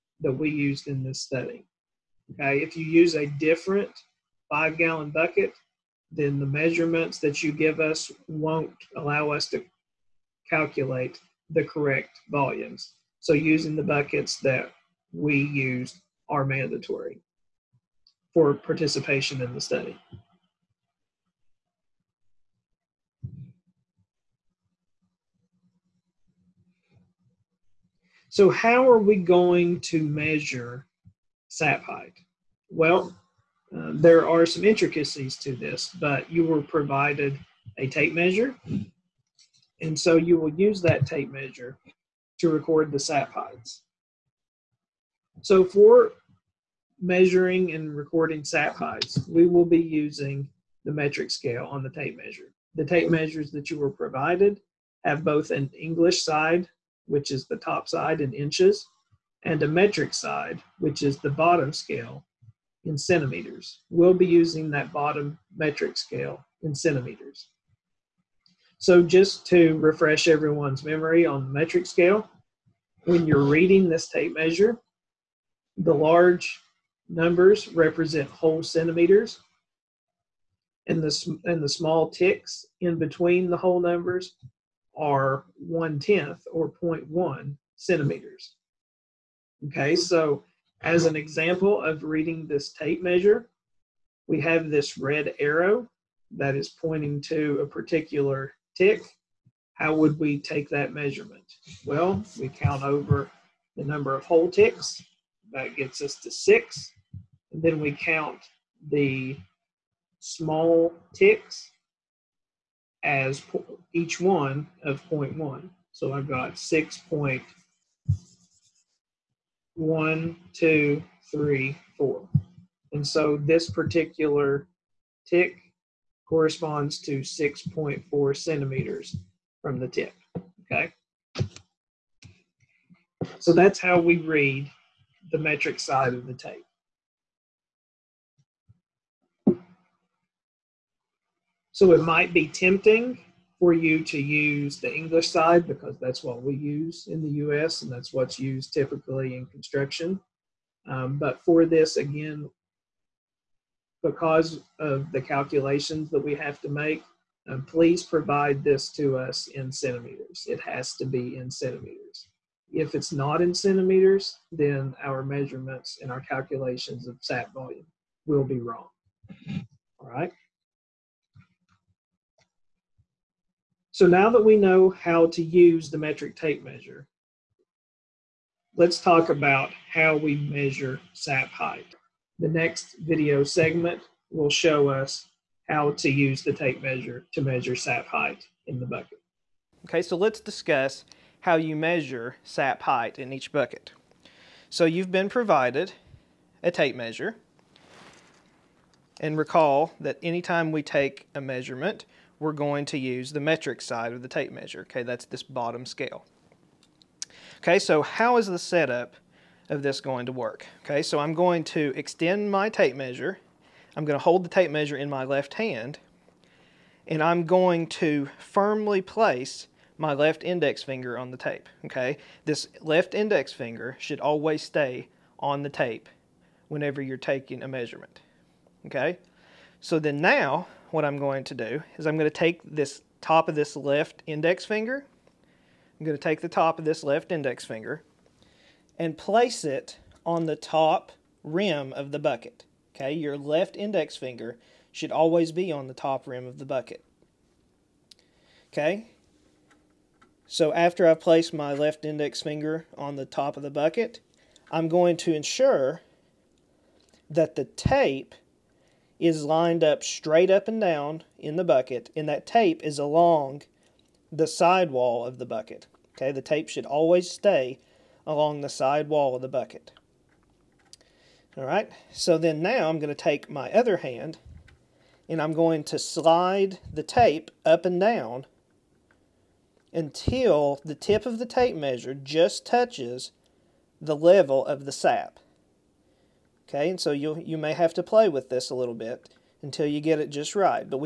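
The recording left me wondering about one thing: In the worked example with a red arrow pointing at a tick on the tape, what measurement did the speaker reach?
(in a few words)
6.4 centimeters.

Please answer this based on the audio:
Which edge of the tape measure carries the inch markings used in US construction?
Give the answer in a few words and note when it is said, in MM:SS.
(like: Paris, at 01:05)
top side, at 00:57.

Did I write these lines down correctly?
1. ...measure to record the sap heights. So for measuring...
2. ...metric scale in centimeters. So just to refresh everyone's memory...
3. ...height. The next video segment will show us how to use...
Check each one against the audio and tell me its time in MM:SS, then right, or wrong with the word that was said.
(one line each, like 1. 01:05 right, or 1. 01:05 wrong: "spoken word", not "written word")
1. 00:41 right
2. 01:05 right
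3. 03:01 right.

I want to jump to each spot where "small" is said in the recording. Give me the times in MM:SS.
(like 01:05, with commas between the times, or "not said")
01:21, 01:50.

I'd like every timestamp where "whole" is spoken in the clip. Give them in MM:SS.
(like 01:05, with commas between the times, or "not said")
01:18, 01:23, 01:44.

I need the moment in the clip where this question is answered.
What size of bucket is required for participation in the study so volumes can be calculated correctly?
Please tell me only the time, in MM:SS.
00:04.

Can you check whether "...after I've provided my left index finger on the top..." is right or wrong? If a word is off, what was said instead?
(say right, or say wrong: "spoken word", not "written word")
wrong: "placed", not "provided".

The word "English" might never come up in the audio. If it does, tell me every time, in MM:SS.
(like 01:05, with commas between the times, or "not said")
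00:55, 02:24.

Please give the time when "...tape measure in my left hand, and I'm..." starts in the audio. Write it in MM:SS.
03:34.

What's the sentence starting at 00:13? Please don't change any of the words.
So using the buckets that we used are mandatory for participation in the study.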